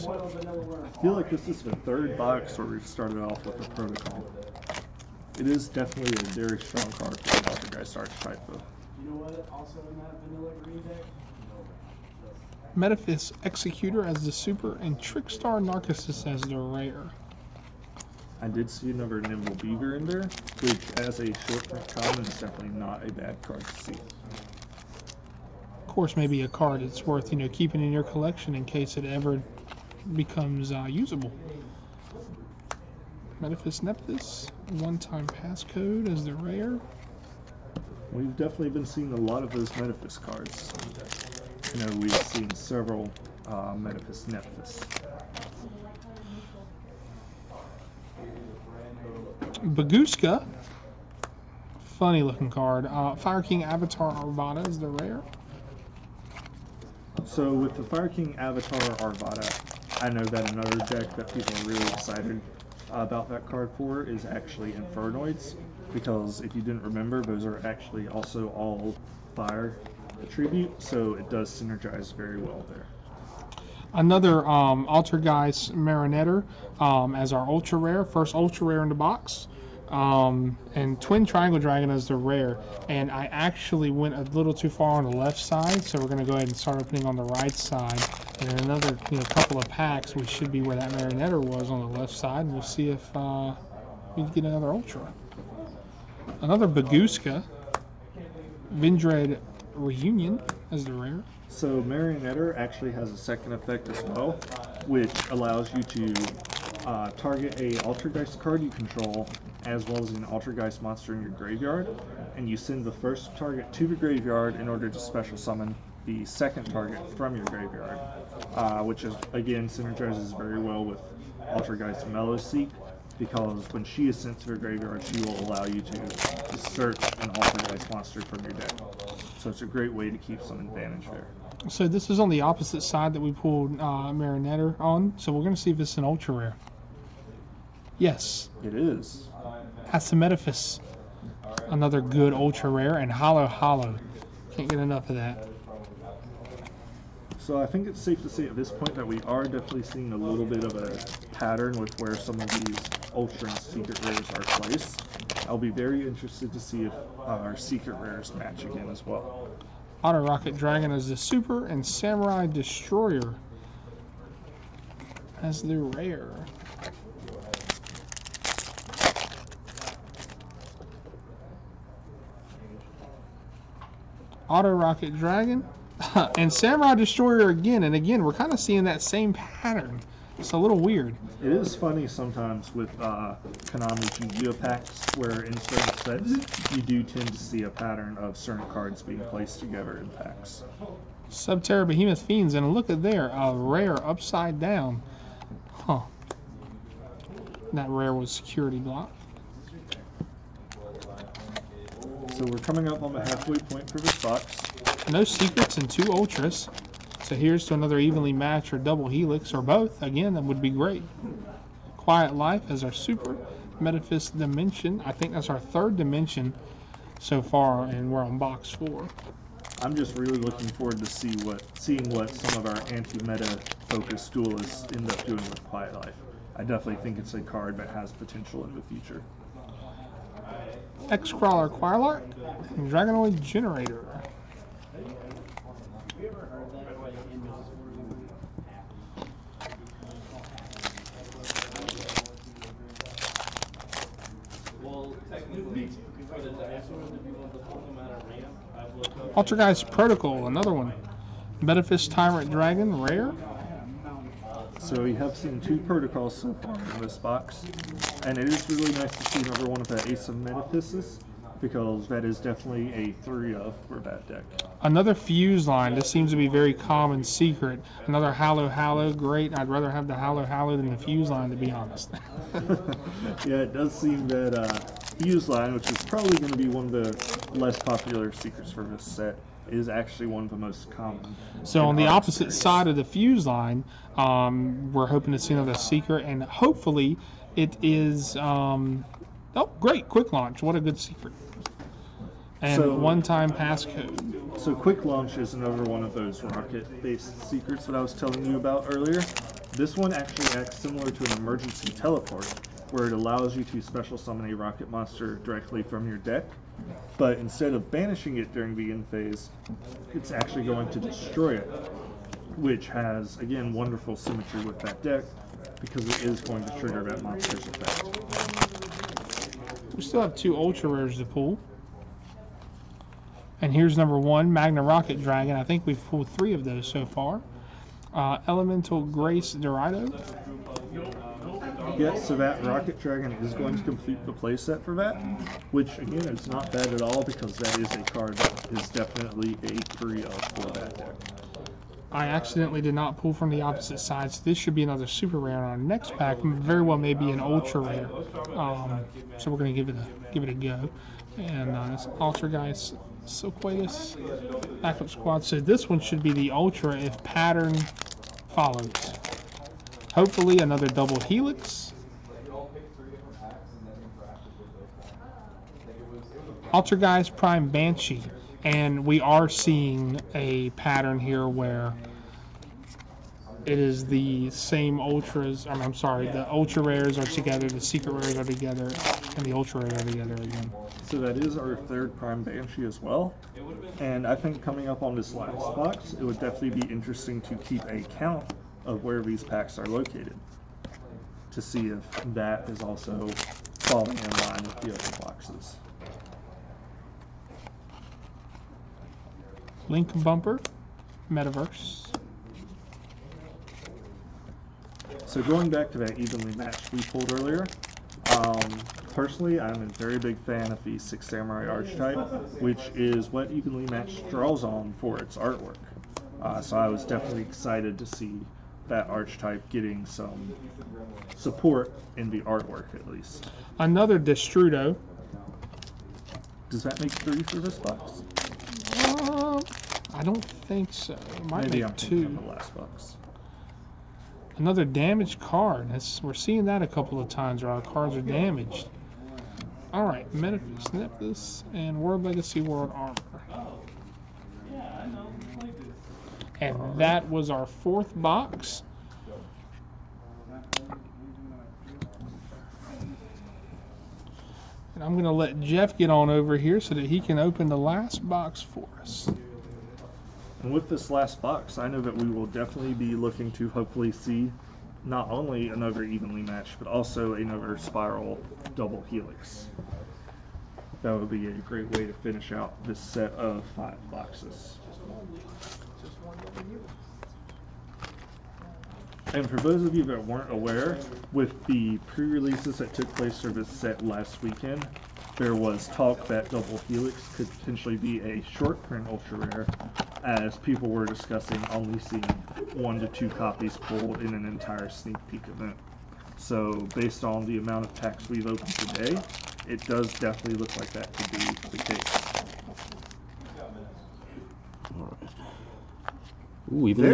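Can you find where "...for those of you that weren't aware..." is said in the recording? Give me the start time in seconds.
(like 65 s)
479 s.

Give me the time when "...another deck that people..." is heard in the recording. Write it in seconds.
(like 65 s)
60 s.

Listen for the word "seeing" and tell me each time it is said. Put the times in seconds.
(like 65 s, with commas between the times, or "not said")
38 s, 149 s, 178 s, 221 s, 369 s, 436 s, 491 s.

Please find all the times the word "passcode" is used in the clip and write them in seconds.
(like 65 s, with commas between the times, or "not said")
35 s, 293 s.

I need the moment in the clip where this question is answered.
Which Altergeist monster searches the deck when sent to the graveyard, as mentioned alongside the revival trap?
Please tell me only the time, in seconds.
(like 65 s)
121 s.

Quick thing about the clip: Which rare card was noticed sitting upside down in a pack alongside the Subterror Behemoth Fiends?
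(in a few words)
Security Block.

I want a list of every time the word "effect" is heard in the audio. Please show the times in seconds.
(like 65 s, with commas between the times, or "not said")
103 s, 317 s.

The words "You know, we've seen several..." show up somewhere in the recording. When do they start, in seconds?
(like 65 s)
41 s.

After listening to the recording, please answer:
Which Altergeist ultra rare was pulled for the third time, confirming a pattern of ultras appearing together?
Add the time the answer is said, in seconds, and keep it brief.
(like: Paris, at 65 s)
Altergeist Prime Banshee, at 366 s.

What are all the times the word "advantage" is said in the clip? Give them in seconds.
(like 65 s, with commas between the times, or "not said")
130 s.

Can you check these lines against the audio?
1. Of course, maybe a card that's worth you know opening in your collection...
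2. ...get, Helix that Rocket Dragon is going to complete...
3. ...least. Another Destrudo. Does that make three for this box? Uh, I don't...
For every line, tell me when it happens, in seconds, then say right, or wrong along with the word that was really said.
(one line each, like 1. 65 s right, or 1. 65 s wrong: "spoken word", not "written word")
1. 24 s wrong: "keeping", not "opening"
2. 331 s wrong: "Savat", not "Helix"
3. 423 s right.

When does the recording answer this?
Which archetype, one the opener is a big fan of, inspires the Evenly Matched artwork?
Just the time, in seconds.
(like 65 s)
410 s.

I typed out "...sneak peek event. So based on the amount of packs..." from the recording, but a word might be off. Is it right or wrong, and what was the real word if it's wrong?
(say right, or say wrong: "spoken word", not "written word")
right.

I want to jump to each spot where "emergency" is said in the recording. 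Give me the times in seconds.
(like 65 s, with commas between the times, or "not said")
301 s.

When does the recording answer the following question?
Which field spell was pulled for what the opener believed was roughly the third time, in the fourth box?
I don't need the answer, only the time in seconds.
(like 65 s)
213 s.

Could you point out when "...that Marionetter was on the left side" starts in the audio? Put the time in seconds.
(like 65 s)
90 s.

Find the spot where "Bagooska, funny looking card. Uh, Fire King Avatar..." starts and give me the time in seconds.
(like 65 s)
49 s.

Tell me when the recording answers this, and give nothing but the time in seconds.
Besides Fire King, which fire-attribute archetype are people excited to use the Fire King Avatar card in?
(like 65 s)
64 s.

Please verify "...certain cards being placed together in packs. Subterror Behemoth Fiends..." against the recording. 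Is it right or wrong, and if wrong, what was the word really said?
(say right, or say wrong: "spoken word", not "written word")
right.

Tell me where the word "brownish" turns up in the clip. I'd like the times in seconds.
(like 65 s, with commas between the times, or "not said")
not said.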